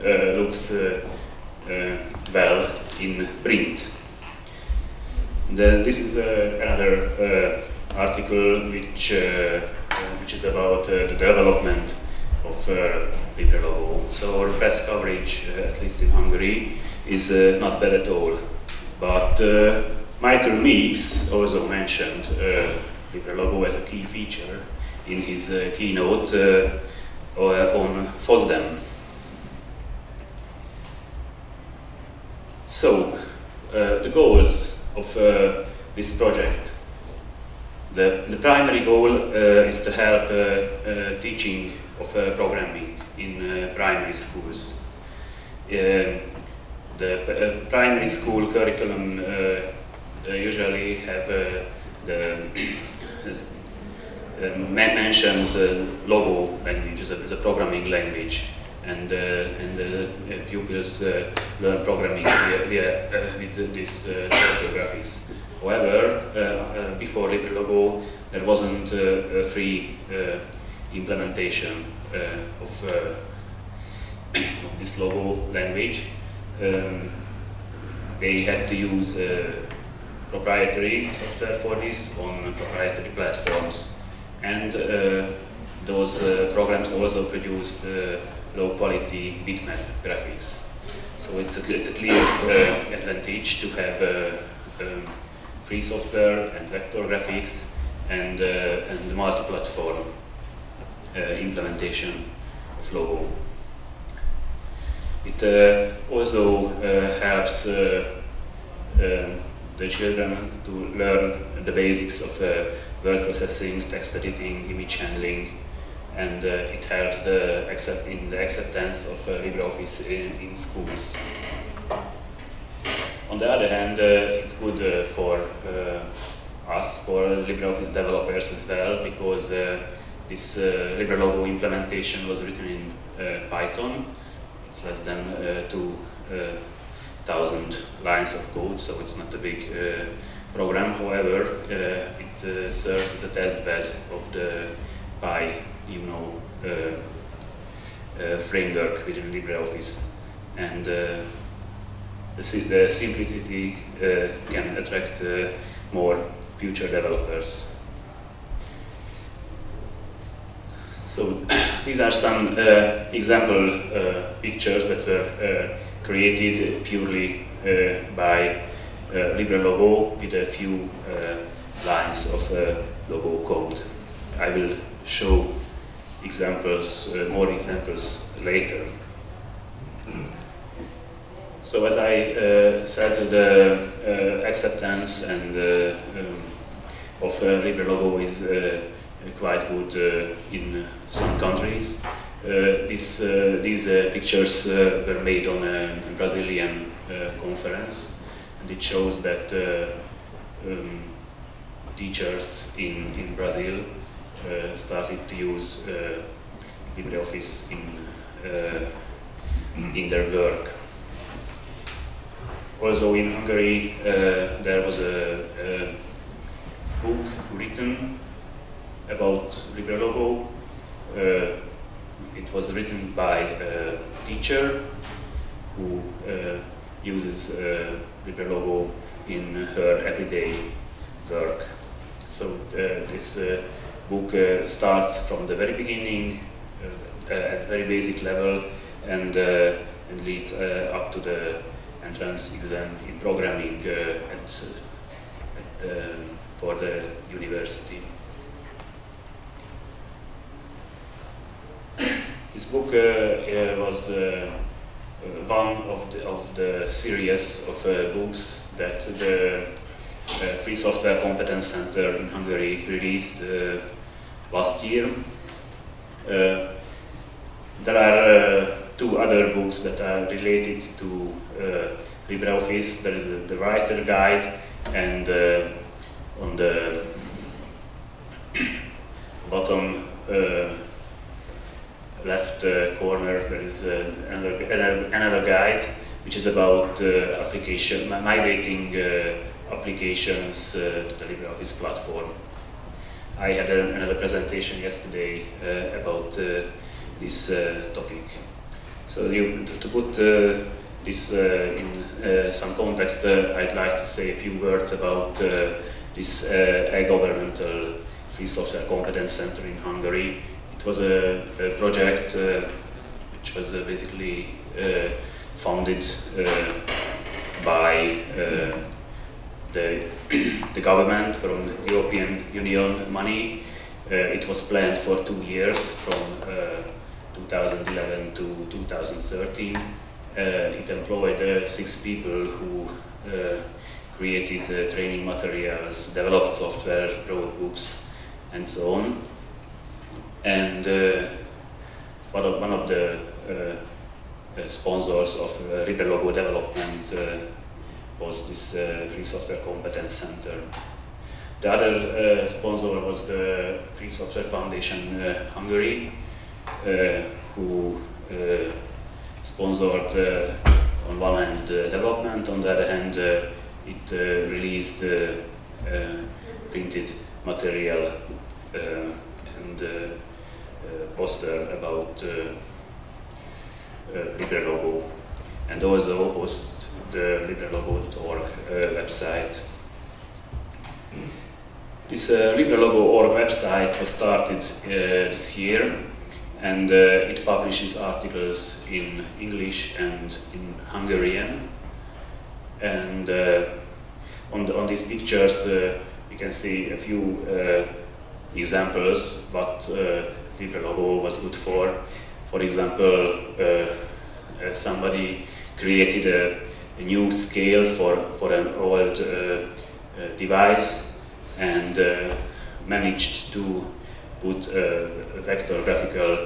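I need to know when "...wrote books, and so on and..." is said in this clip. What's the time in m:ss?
5:37.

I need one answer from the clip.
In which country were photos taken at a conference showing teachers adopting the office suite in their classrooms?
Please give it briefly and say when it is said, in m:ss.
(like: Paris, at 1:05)
Brazil, at 3:16.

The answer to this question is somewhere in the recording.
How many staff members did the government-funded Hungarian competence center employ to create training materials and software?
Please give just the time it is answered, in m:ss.
5:31.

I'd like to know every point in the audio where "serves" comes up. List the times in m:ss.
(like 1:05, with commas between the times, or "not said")
2:22.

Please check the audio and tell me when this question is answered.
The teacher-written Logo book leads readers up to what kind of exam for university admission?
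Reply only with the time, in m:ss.
4:02.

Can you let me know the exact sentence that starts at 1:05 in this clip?
However, before LibreLogo there wasn't a free implementation uh, of, uh, of, this logo language.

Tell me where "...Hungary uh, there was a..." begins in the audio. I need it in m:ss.
3:33.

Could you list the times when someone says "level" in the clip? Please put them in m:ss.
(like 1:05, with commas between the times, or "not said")
3:58.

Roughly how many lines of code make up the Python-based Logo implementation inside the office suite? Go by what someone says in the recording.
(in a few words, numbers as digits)
less than 2000.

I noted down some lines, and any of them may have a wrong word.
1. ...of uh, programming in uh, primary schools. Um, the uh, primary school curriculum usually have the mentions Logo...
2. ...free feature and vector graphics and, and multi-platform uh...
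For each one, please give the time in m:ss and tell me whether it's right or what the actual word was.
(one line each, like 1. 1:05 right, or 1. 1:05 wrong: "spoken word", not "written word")
1. 0:41 right
2. 1:35 wrong: "software", not "feature".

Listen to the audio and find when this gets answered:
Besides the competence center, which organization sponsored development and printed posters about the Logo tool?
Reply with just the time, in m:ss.
5:53.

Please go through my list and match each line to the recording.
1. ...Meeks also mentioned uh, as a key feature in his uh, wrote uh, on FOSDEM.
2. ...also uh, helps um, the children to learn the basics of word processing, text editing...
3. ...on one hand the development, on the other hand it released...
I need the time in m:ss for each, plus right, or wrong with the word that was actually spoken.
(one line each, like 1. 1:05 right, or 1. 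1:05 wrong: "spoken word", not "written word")
1. 0:20 wrong: "keynote", not "wrote"
2. 1:46 right
3. 6:01 right.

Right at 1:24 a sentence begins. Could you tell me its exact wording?
And uh, those uh, programs also produced uh, low quality bitmap graphics.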